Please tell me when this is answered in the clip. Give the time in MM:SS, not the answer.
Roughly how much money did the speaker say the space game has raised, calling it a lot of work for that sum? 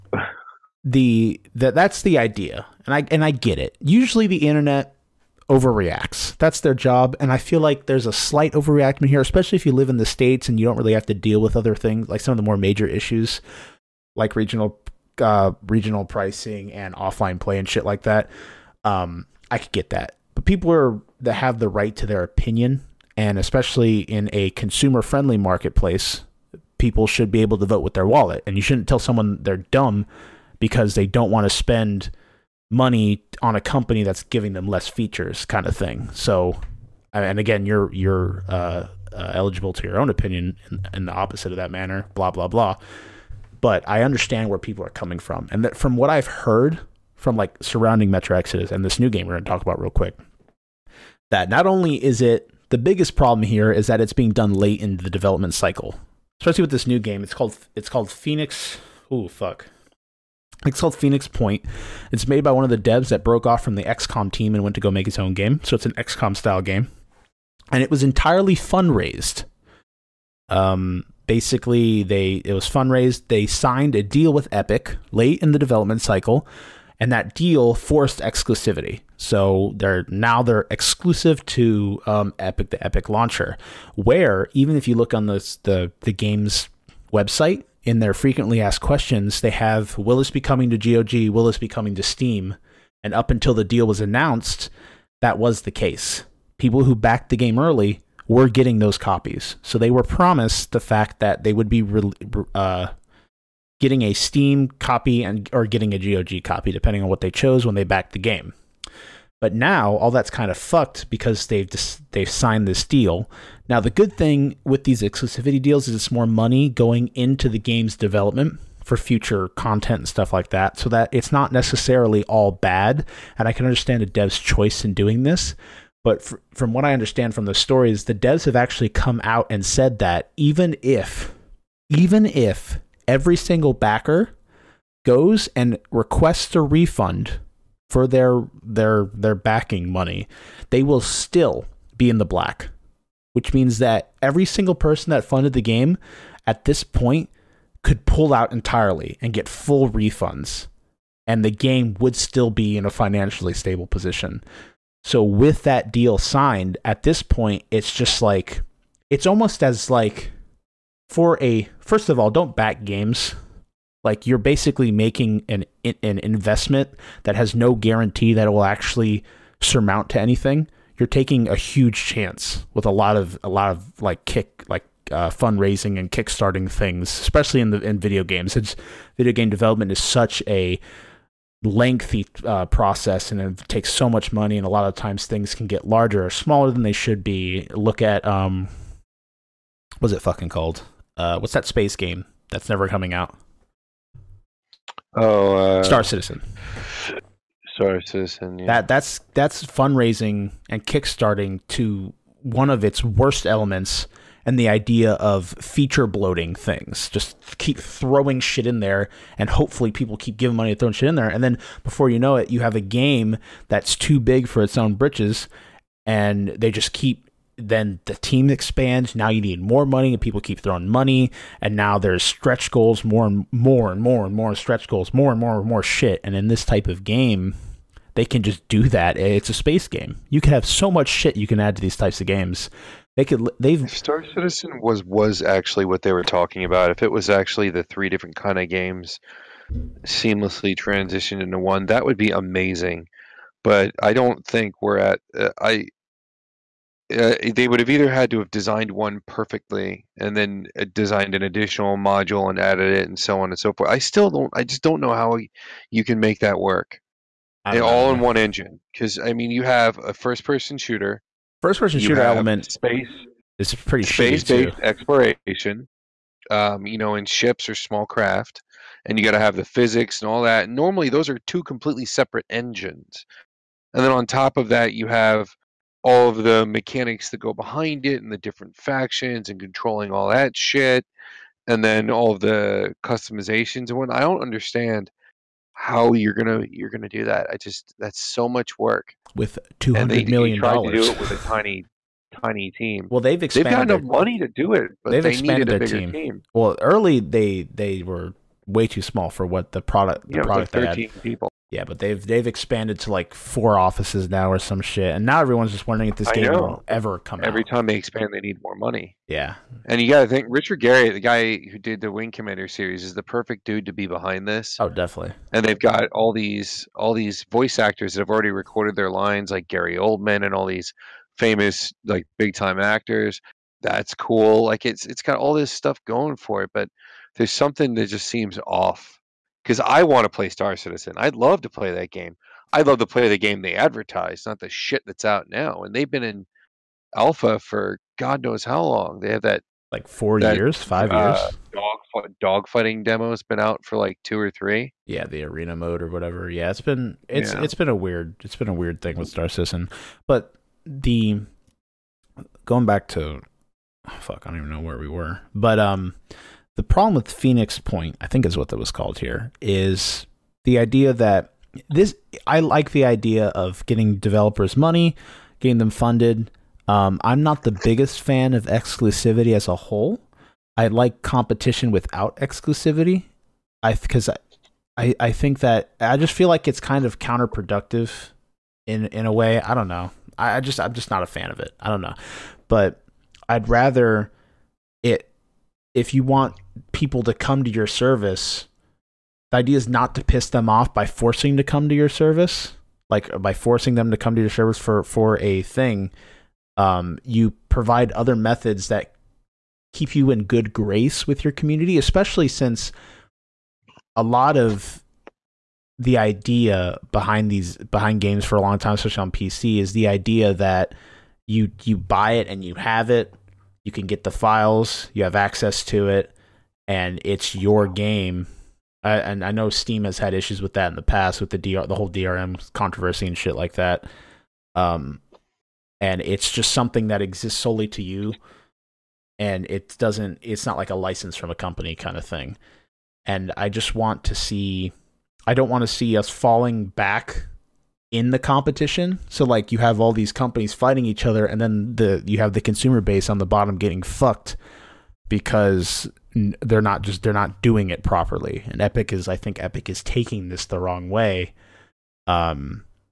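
04:49.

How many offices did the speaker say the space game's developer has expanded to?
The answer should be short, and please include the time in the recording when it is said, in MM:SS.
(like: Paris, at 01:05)
4, at 05:03.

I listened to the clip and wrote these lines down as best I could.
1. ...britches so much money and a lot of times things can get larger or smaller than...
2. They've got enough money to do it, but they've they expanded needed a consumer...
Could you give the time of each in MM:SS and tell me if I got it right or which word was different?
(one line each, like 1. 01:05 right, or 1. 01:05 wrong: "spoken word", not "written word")
1. 03:03 wrong: "takes", not "britches"
2. 04:53 wrong: "bigger", not "consumer".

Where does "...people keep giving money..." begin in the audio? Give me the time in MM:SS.
03:29.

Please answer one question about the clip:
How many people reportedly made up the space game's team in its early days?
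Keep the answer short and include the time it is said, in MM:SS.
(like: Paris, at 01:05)
13, at 05:00.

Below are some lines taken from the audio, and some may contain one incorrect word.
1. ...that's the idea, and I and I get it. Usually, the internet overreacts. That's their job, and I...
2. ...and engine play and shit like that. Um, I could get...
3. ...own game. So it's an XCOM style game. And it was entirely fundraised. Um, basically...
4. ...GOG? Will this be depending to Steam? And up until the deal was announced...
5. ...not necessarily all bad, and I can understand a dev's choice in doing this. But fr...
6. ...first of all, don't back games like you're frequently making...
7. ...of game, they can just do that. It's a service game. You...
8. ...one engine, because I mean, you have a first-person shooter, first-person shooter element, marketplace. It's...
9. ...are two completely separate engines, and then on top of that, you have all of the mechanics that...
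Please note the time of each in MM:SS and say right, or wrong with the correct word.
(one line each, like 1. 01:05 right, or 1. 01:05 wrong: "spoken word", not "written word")
1. 00:01 right
2. 00:16 wrong: "offline", not "engine"
3. 01:05 right
4. 01:30 wrong: "coming", not "depending"
5. 02:01 right
6. 02:41 wrong: "basically", not "frequently"
7. 03:46 wrong: "space", not "service"
8. 04:18 wrong: "space", not "marketplace"
9. 04:31 right.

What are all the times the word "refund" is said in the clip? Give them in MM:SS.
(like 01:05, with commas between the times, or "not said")
02:16, 02:29.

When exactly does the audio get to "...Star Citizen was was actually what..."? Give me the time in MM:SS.
03:53.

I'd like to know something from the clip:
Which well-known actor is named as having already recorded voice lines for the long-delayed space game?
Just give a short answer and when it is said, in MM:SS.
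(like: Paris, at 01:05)
Gary Oldman, at 05:19.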